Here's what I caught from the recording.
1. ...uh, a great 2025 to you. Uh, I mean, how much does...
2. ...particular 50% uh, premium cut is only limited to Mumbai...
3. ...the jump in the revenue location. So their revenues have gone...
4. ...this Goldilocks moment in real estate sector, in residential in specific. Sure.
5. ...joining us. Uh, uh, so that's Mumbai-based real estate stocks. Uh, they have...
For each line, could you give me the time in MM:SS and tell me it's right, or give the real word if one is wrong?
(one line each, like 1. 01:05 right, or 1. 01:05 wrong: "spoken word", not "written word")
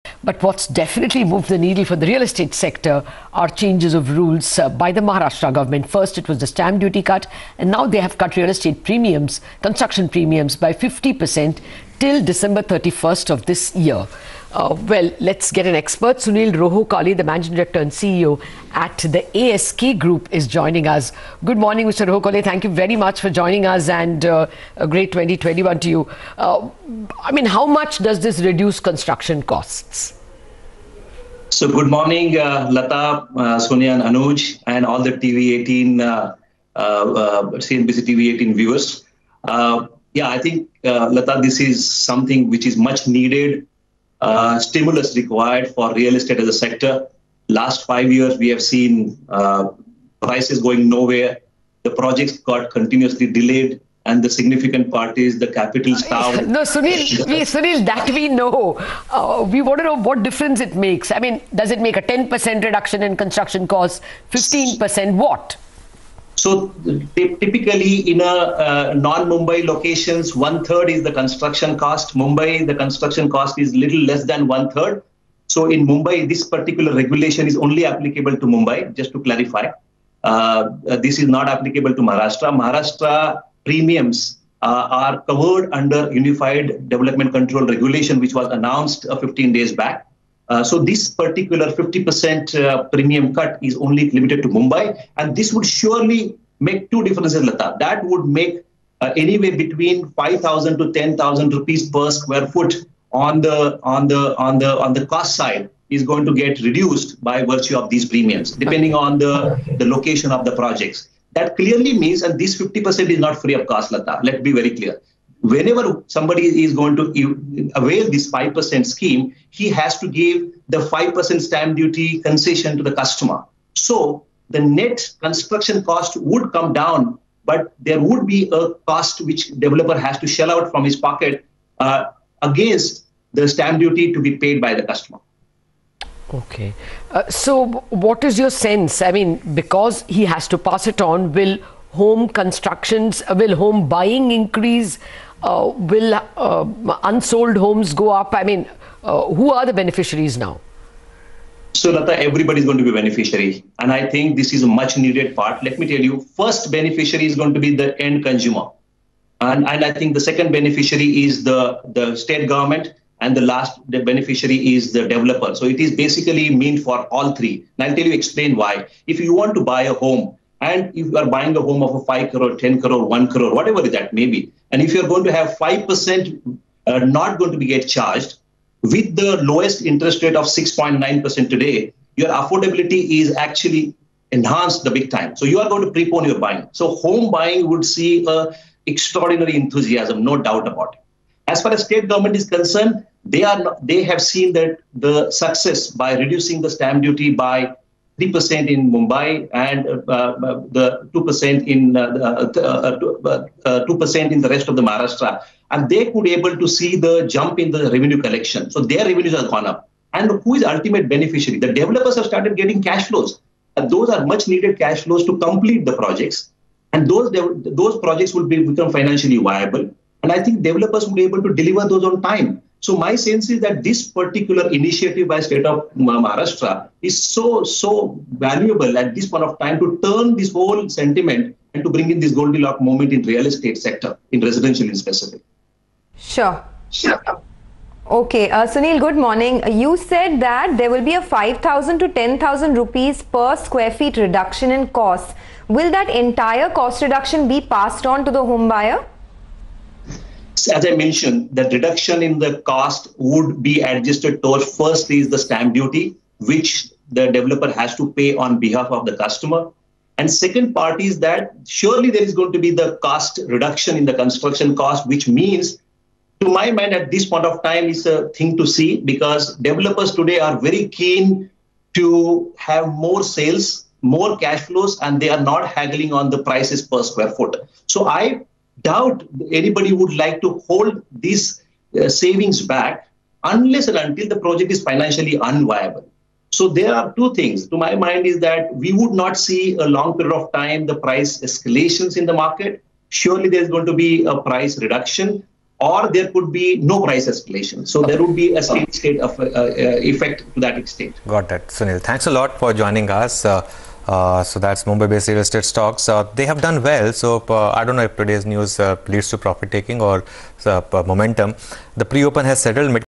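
1. 00:24 wrong: "2021", not "2025"
2. 01:31 right
3. 03:26 wrong: "collection", not "location"
4. 03:52 right
5. 05:02 right.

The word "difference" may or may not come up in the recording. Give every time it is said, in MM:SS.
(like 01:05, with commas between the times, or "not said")
01:00, 01:37.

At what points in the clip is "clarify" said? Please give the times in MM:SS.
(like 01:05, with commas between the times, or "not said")
01:19.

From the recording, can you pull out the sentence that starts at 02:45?
So it is basically meant for all three.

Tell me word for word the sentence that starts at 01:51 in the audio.
That clearly means, and this 50% is not free of cost, Lata.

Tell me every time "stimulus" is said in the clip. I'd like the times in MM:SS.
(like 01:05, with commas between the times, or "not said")
00:44.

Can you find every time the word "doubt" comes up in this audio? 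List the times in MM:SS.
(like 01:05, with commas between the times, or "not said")
03:10, 04:38.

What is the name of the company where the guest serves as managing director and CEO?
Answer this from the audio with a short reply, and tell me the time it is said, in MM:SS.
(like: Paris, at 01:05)
ASK Group, at 00:19.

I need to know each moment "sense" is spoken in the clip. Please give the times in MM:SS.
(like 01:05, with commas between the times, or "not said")
02:18, 03:43.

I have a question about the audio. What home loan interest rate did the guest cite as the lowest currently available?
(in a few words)
6.9%.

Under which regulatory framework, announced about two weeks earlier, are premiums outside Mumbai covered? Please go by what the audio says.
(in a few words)
Unified Development Control Regulation.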